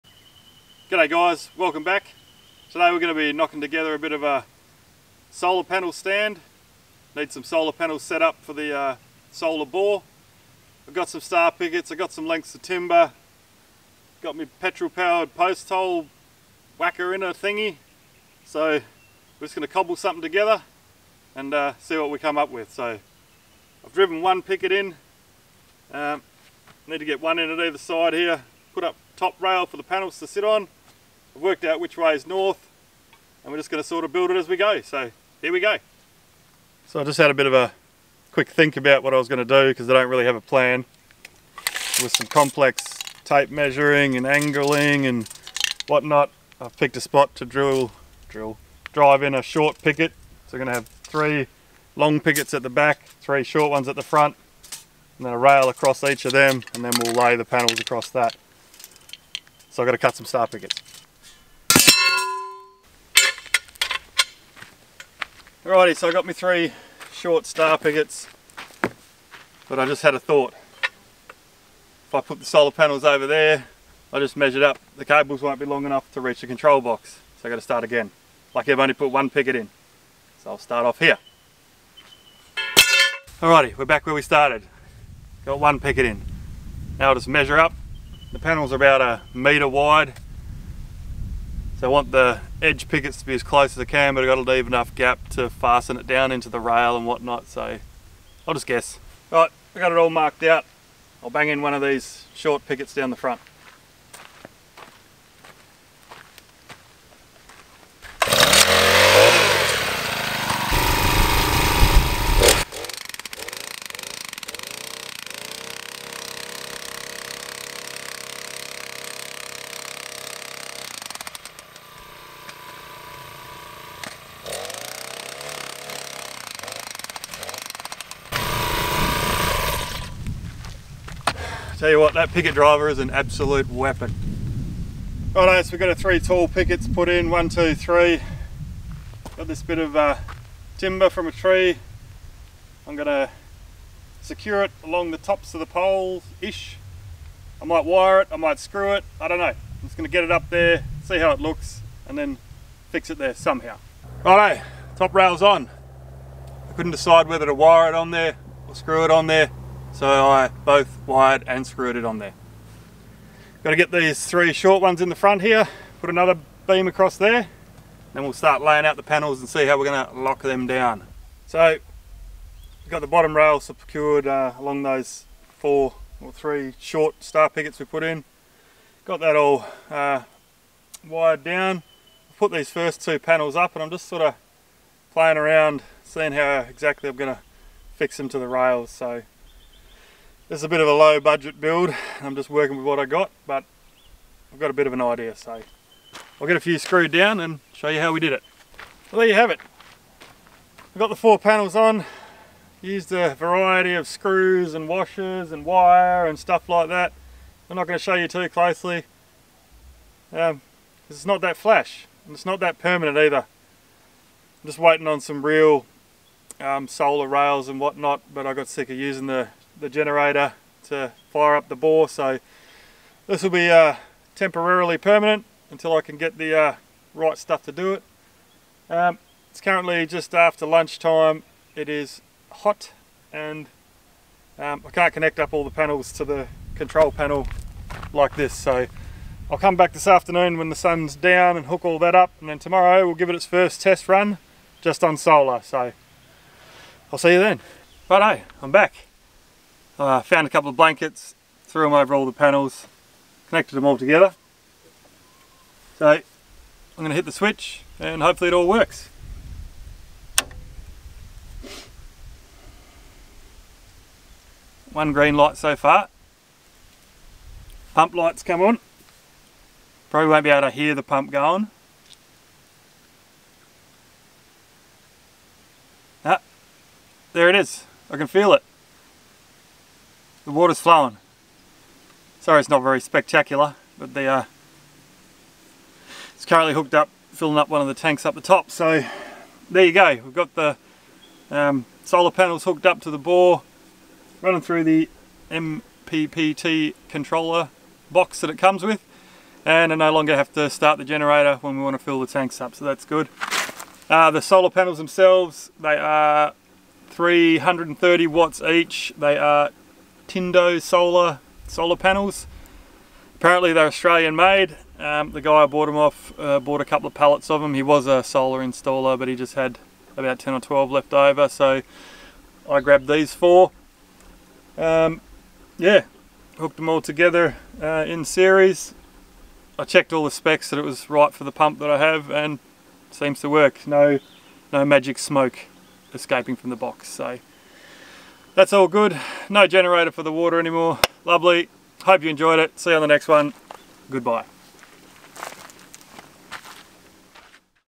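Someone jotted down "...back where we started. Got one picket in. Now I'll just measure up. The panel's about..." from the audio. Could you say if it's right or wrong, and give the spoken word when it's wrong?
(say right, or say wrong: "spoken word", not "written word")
right.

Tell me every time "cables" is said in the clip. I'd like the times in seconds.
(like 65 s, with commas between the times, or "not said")
75 s.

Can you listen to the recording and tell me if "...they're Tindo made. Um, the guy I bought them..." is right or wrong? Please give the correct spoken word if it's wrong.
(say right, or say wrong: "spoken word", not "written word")
wrong: "Australian", not "Tindo".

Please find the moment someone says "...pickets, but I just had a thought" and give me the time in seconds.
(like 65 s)
67 s.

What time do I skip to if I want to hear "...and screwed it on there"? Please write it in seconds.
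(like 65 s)
161 s.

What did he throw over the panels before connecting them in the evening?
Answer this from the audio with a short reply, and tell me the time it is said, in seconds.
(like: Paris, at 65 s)
Blankets, at 250 s.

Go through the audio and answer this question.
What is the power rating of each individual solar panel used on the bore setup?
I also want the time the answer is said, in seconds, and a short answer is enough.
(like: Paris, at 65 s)
330 watts, at 307 s.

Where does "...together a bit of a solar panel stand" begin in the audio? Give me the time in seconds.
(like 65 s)
3 s.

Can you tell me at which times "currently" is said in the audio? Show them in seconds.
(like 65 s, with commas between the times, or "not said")
229 s, 286 s.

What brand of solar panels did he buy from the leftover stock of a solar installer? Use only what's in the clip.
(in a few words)
Tindo.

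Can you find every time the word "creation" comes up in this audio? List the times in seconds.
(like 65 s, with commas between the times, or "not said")
not said.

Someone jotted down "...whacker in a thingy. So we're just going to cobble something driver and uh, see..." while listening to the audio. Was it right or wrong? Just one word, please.
wrong.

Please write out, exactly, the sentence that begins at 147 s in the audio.
I might wire it, I might screw it, I don't know.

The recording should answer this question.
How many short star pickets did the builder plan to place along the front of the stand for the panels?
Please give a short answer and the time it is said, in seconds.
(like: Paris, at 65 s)
3, at 53 s.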